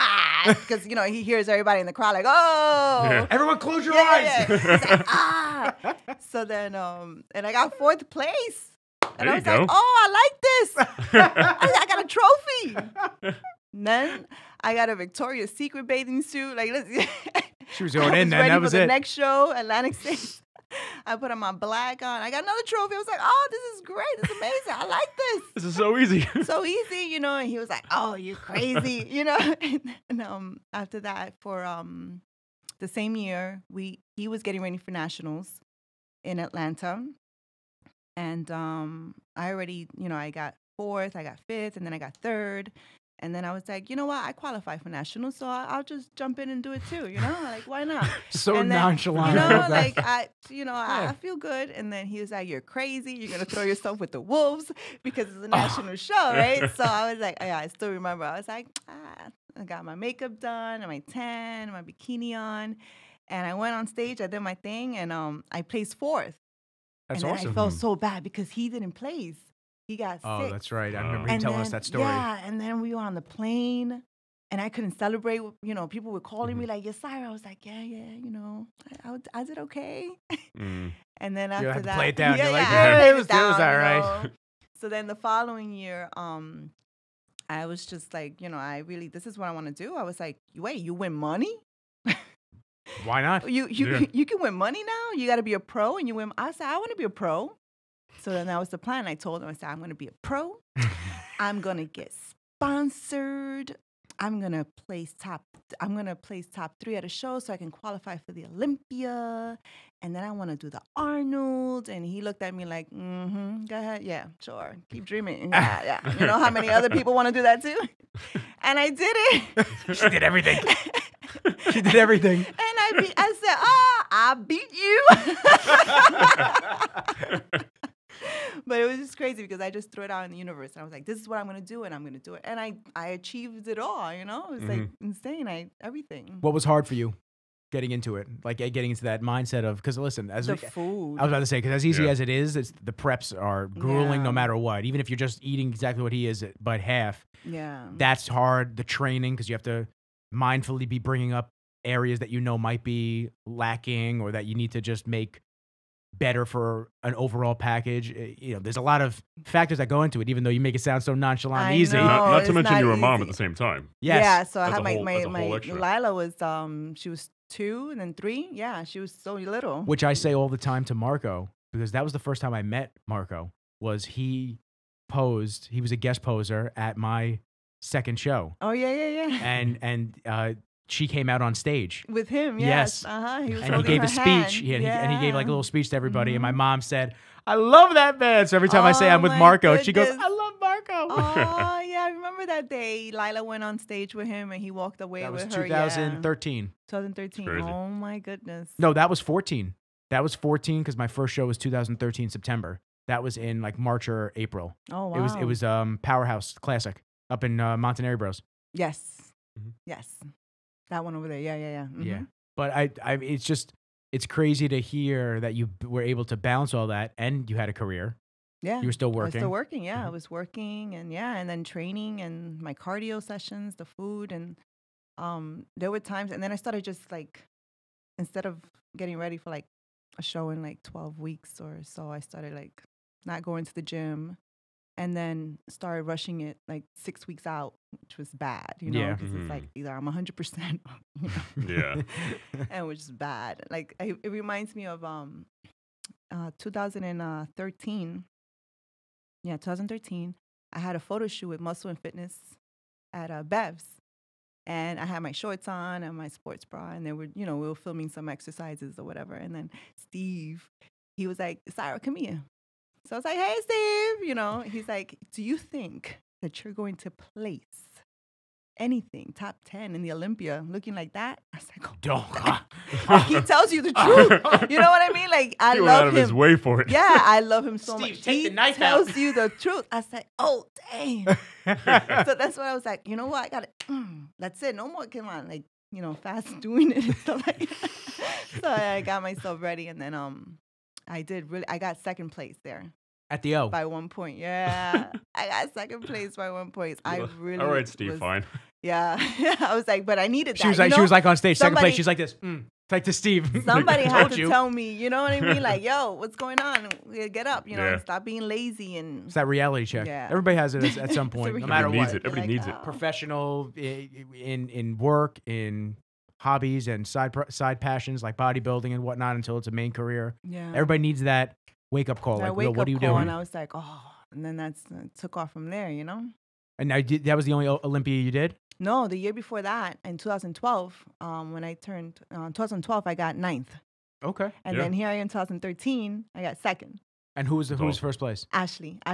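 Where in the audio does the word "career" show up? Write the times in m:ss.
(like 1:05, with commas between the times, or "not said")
3:37, 5:19.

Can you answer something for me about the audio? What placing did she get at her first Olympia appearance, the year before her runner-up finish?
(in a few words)
9th.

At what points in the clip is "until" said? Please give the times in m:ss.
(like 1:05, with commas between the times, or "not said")
5:19.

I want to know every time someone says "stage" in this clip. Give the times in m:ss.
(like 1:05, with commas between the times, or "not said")
1:03, 3:01, 3:13, 5:01.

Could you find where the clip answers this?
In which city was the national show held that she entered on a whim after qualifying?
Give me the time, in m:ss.
0:36.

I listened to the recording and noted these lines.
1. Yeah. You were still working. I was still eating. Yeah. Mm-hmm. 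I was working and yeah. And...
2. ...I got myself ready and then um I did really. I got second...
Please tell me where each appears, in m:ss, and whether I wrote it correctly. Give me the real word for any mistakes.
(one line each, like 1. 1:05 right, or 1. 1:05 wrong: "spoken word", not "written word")
1. 3:38 wrong: "working", not "eating"
2. 4:48 right.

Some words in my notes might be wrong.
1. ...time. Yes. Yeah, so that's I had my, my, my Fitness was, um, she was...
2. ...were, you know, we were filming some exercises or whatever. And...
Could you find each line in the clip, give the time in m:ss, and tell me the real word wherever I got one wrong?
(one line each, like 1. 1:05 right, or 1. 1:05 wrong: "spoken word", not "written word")
1. 2:43 wrong: "Lila", not "Fitness"
2. 4:17 right.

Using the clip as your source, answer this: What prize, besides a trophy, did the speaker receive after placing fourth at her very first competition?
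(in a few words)
Victoria's Secret bathing suit.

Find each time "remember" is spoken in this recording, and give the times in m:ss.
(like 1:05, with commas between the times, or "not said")
0:57, 1:10, 3:12.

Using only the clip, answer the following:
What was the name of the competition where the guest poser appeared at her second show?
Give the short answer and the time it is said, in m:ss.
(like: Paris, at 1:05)
Powerhouse Classic, at 3:26.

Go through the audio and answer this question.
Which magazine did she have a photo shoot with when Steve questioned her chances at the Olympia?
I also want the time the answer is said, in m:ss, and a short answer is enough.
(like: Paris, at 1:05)
Muscle and Fitness, at 4:11.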